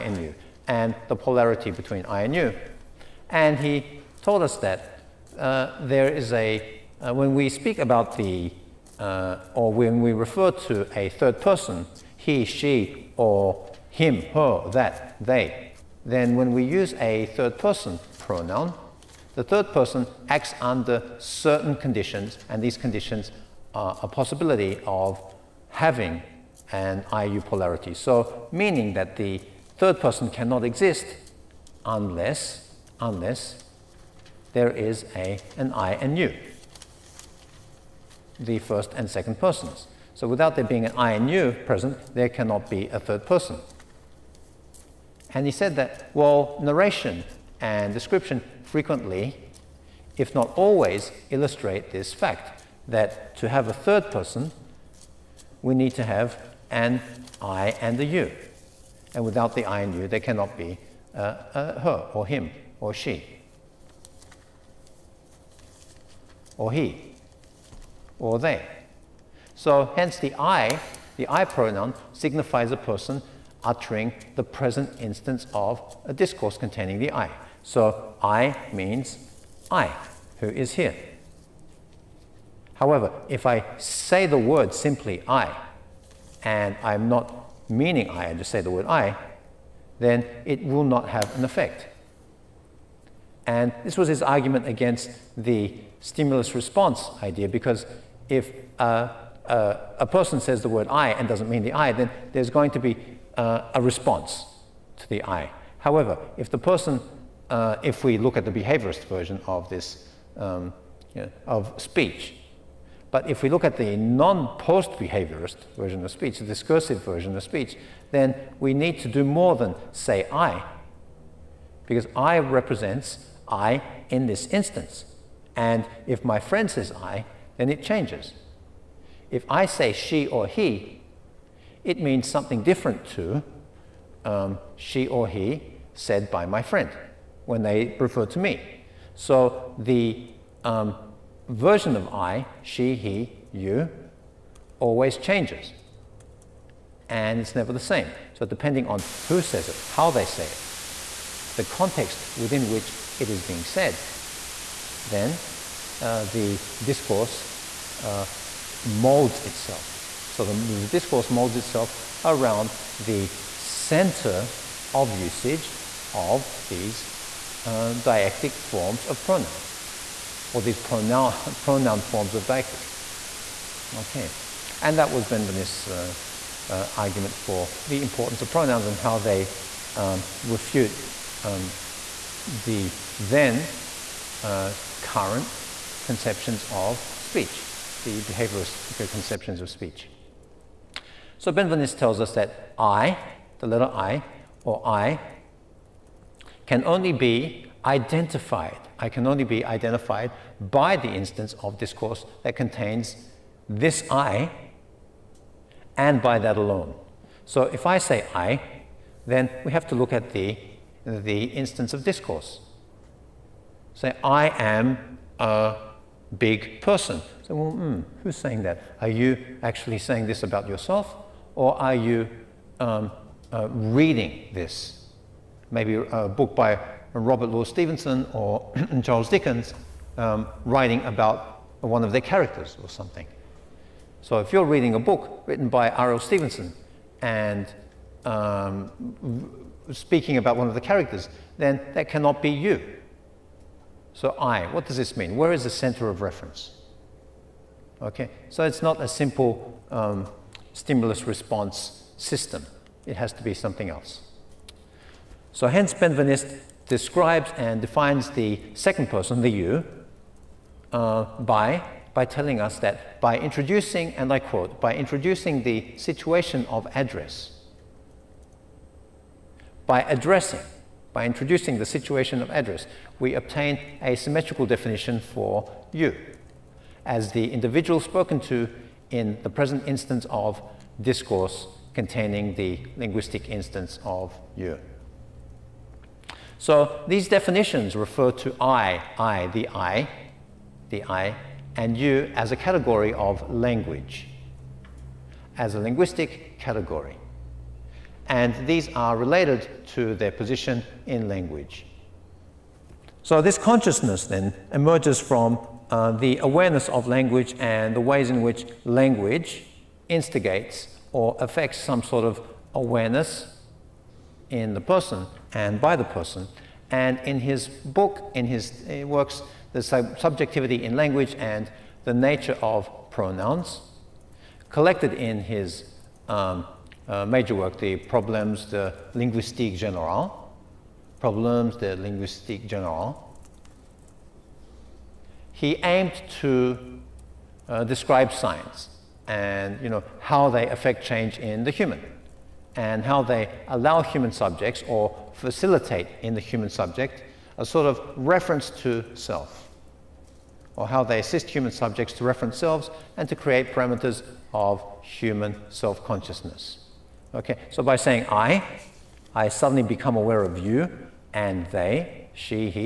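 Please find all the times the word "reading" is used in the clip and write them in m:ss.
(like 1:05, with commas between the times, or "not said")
3:43, 3:54.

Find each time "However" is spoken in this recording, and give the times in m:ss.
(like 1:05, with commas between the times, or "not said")
1:22, 1:45.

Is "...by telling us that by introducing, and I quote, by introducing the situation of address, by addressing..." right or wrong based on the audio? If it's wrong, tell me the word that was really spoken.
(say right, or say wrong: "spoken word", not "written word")
right.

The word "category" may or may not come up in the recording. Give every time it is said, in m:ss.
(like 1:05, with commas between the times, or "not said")
4:52, 4:56.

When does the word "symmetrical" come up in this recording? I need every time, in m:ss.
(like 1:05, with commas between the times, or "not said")
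4:34.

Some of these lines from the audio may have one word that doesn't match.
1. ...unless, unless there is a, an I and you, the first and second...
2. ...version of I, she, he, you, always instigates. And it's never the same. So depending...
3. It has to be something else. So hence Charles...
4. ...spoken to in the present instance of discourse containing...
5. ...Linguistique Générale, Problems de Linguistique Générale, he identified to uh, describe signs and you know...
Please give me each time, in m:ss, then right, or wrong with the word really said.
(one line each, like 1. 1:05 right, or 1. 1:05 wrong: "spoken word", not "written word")
1. 0:31 right
2. 2:21 wrong: "changes", not "instigates"
3. 4:13 wrong: "Benveniste", not "Charles"
4. 4:38 right
5. 5:29 wrong: "aimed", not "identified".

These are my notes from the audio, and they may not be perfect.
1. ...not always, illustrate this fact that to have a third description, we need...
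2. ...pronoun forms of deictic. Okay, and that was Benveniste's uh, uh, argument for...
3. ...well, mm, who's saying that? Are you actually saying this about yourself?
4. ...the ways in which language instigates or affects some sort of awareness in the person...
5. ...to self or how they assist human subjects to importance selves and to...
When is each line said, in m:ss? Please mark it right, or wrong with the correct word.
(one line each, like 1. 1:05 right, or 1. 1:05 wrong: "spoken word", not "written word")
1. 0:50 wrong: "person", not "description"
2. 2:51 right
3. 3:37 right
4. 5:07 right
5. 5:48 wrong: "reference", not "importance".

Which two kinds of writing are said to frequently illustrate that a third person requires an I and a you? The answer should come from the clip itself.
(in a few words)
narration and description.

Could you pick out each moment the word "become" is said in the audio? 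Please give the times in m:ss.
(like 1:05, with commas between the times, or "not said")
5:59.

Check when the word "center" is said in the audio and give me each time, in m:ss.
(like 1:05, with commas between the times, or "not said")
2:43, 4:05.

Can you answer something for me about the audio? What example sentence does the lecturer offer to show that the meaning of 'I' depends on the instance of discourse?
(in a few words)
I am a big person.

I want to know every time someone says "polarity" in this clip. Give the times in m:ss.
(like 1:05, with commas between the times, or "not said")
0:01, 0:27.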